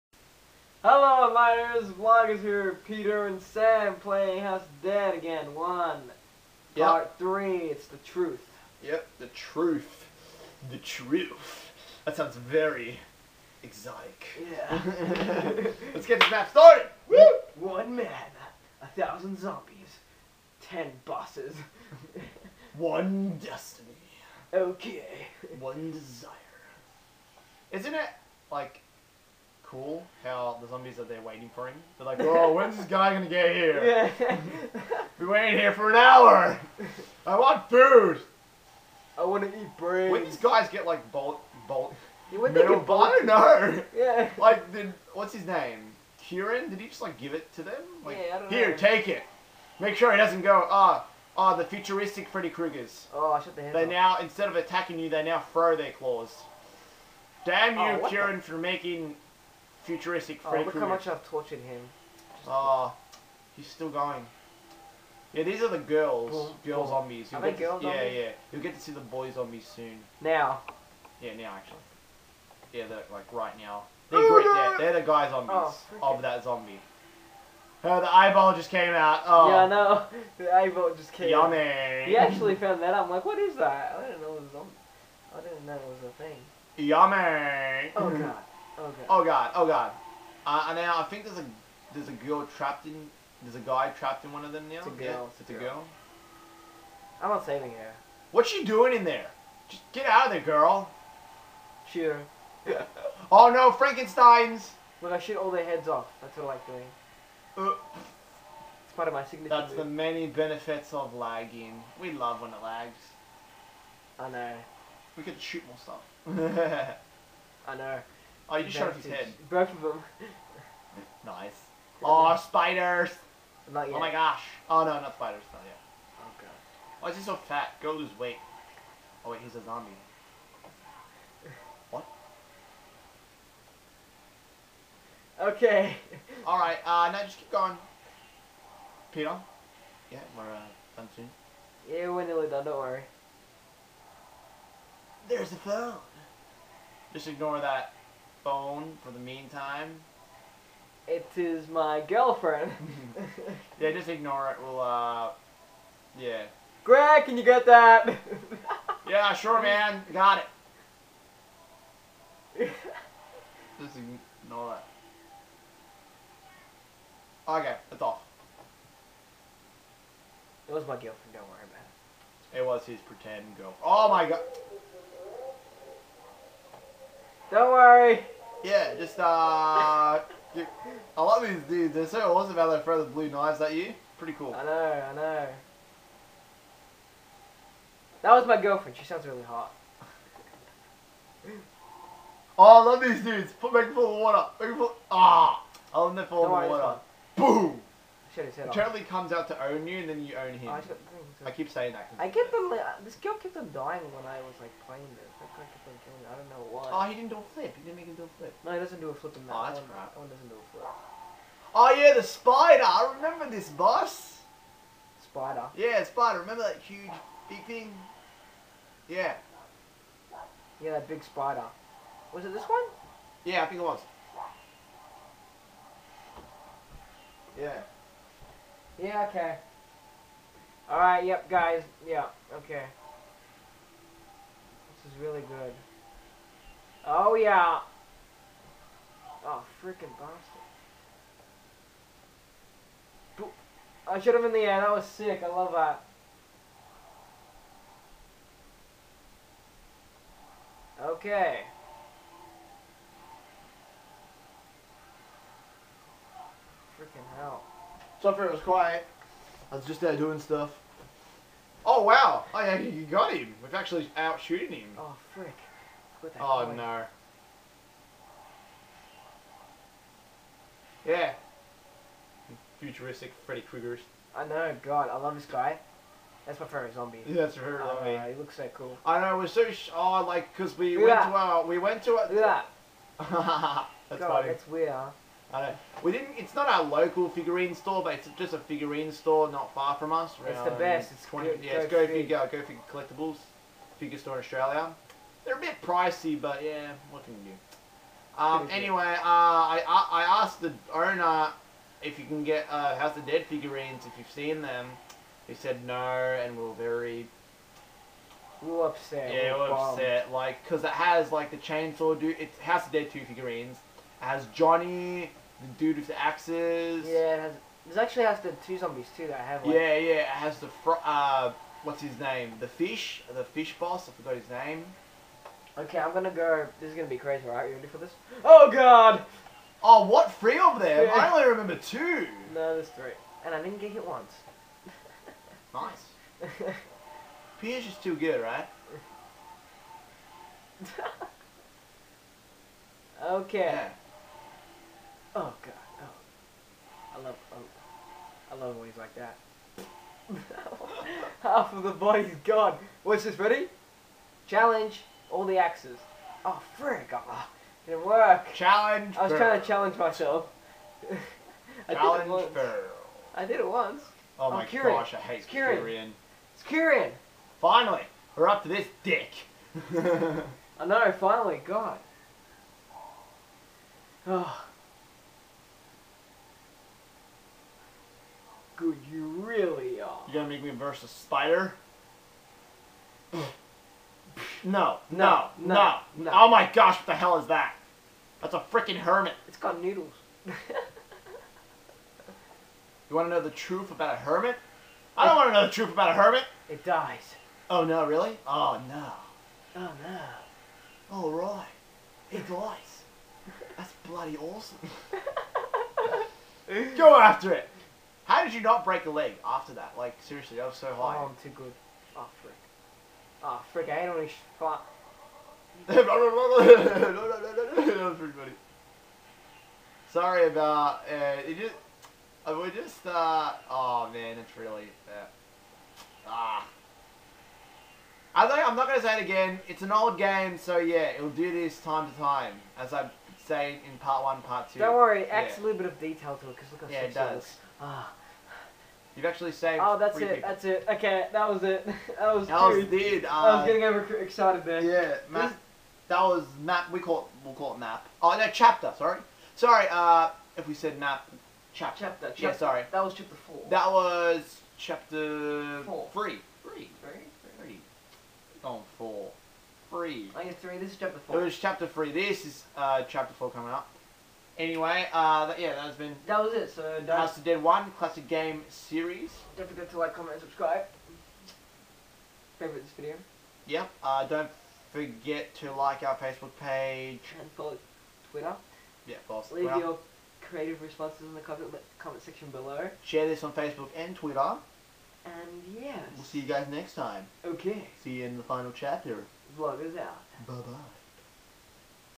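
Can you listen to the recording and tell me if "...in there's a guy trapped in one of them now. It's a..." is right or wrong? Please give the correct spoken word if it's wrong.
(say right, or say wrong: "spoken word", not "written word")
right.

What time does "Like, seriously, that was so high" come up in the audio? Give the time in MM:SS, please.
06:49.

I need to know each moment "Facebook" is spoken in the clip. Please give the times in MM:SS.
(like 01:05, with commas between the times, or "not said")
07:56, 08:03.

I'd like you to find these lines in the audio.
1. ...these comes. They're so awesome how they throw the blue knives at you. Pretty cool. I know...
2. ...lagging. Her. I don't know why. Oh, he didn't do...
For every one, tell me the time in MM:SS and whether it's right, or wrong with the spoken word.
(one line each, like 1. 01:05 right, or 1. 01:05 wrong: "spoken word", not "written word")
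1. 03:01 wrong: "dudes", not "comes"
2. 03:26 wrong: "killing", not "lagging".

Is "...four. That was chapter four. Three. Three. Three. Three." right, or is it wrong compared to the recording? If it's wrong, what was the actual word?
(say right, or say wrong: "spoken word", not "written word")
right.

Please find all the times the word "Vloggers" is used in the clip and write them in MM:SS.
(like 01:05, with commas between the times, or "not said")
00:01, 08:09.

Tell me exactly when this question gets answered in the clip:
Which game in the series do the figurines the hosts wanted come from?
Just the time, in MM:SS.
05:12.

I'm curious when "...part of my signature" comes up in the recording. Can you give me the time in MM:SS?
01:48.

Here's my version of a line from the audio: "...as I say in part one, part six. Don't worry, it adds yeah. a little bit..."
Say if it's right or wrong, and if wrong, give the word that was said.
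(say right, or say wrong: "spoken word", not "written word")
wrong: "two", not "six".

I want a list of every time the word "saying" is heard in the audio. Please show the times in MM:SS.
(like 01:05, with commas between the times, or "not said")
03:21.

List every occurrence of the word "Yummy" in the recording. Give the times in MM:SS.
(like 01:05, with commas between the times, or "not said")
01:21, 01:26.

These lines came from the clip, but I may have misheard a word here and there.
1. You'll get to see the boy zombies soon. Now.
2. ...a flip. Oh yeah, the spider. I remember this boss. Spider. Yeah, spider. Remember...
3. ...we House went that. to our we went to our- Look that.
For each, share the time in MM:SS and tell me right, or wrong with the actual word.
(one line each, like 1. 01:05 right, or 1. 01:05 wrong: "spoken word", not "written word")
1. 01:08 right
2. 03:30 right
3. 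04:40 wrong: "Look", not "House".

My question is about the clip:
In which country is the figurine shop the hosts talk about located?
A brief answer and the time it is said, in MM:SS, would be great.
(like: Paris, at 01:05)
Australia, at 04:54.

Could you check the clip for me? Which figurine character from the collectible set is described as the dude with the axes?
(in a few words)
Johnny.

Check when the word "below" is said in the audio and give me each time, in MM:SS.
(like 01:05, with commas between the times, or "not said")
08:02.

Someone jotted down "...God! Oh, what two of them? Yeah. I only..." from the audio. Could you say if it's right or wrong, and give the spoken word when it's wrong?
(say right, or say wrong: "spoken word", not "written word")
wrong: "three", not "two".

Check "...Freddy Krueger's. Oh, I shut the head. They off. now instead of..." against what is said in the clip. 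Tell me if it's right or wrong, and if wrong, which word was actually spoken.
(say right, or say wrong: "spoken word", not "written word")
right.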